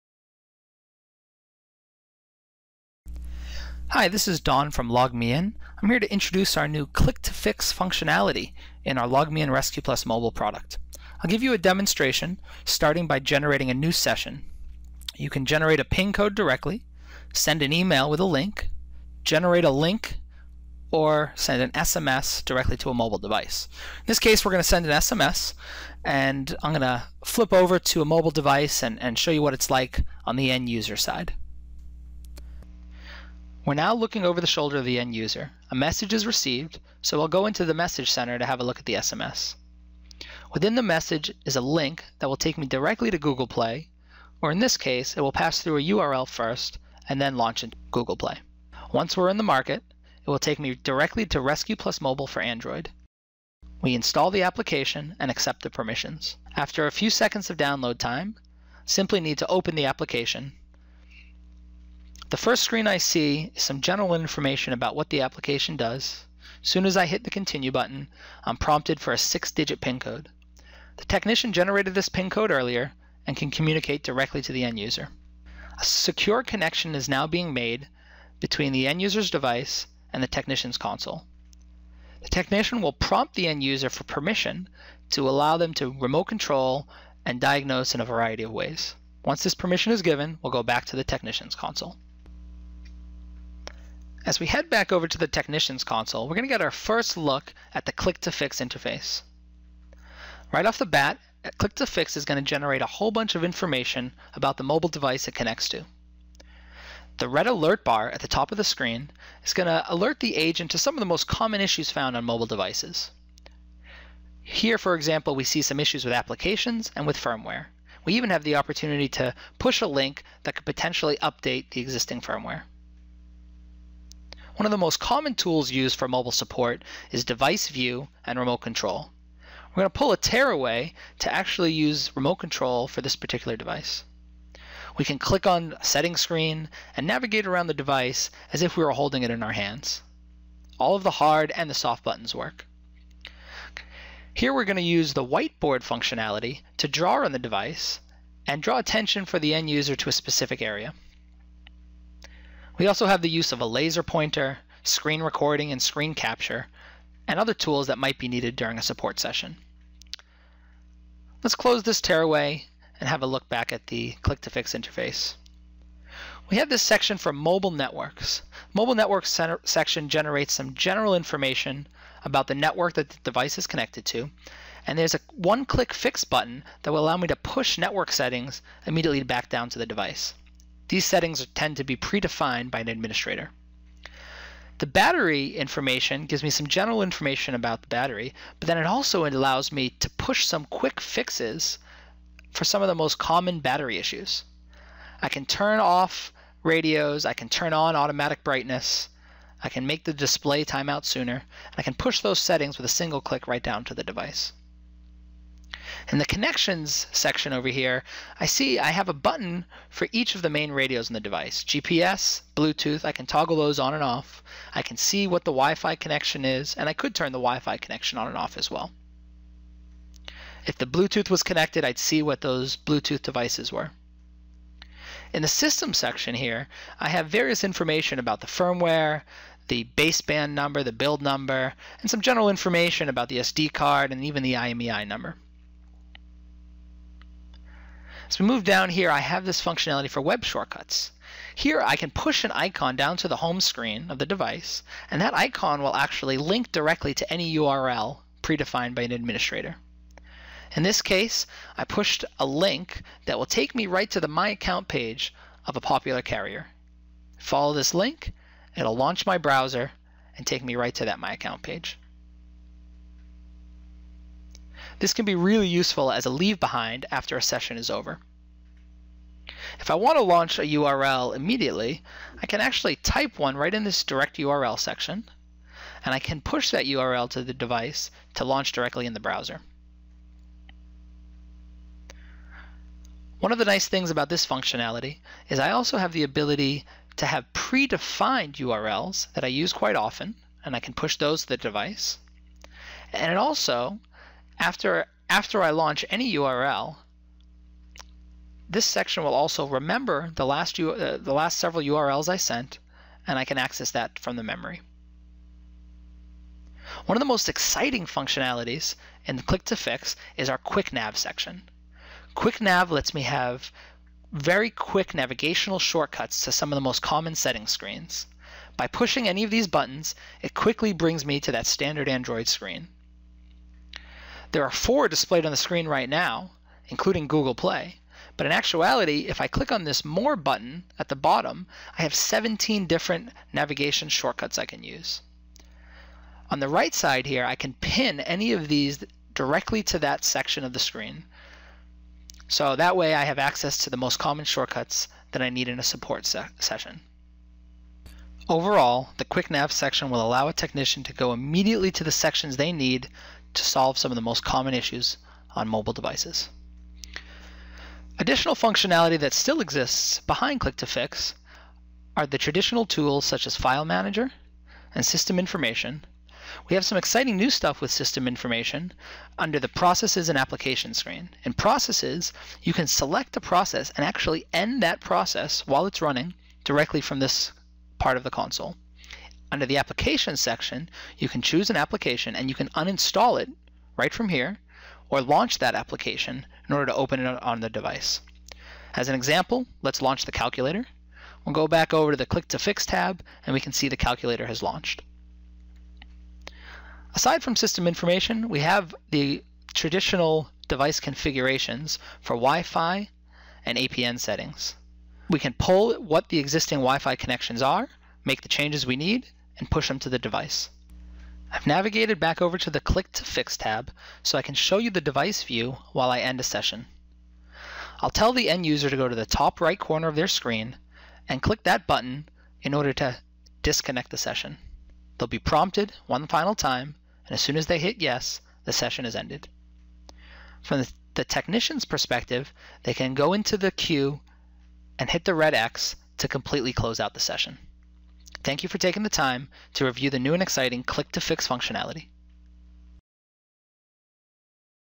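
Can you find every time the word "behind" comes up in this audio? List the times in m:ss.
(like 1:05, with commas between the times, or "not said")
4:26, 6:00.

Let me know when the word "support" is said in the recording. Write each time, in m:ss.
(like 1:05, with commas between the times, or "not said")
2:06, 2:38, 5:45.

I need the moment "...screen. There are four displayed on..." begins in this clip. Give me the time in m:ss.
5:22.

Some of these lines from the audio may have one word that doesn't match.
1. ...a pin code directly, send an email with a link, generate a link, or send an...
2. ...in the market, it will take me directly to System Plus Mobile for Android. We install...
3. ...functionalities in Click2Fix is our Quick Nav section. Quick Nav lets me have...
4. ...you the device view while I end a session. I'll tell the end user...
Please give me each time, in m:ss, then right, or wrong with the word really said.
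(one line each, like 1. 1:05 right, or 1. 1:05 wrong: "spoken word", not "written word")
1. 0:15 right
2. 0:49 wrong: "Rescue", not "System"
3. 5:08 right
4. 6:54 right.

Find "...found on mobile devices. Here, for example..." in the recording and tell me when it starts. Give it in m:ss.
1:51.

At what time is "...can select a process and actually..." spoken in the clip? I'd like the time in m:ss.
6:12.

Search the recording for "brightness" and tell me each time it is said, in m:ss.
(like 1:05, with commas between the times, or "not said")
3:18.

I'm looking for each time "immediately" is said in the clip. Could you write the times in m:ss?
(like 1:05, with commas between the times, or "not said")
2:58, 4:31, 5:51.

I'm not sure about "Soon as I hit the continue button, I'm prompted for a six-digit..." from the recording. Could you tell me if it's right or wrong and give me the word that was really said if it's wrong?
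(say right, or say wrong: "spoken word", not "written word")
right.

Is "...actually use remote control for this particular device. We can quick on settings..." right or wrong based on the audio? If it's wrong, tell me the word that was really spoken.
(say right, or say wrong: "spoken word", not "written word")
wrong: "click", not "quick".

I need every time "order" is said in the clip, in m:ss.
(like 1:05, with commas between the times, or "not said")
6:26, 7:02.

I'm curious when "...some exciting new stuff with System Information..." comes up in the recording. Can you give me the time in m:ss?
6:06.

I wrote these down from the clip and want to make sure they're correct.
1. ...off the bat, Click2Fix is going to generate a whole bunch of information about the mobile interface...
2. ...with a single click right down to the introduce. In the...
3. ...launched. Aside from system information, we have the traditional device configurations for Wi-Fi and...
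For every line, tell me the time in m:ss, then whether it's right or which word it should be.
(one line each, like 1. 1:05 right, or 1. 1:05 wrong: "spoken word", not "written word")
1. 1:40 wrong: "device", not "interface"
2. 3:22 wrong: "device", not "introduce"
3. 6:34 right.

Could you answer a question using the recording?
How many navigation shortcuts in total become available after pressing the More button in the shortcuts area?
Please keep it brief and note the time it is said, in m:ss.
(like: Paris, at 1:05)
17, at 5:32.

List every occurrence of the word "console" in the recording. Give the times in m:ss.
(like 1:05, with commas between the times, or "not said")
1:20, 1:31, 1:35, 6:18.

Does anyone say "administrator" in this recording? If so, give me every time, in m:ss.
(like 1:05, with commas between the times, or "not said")
3:02, 4:09.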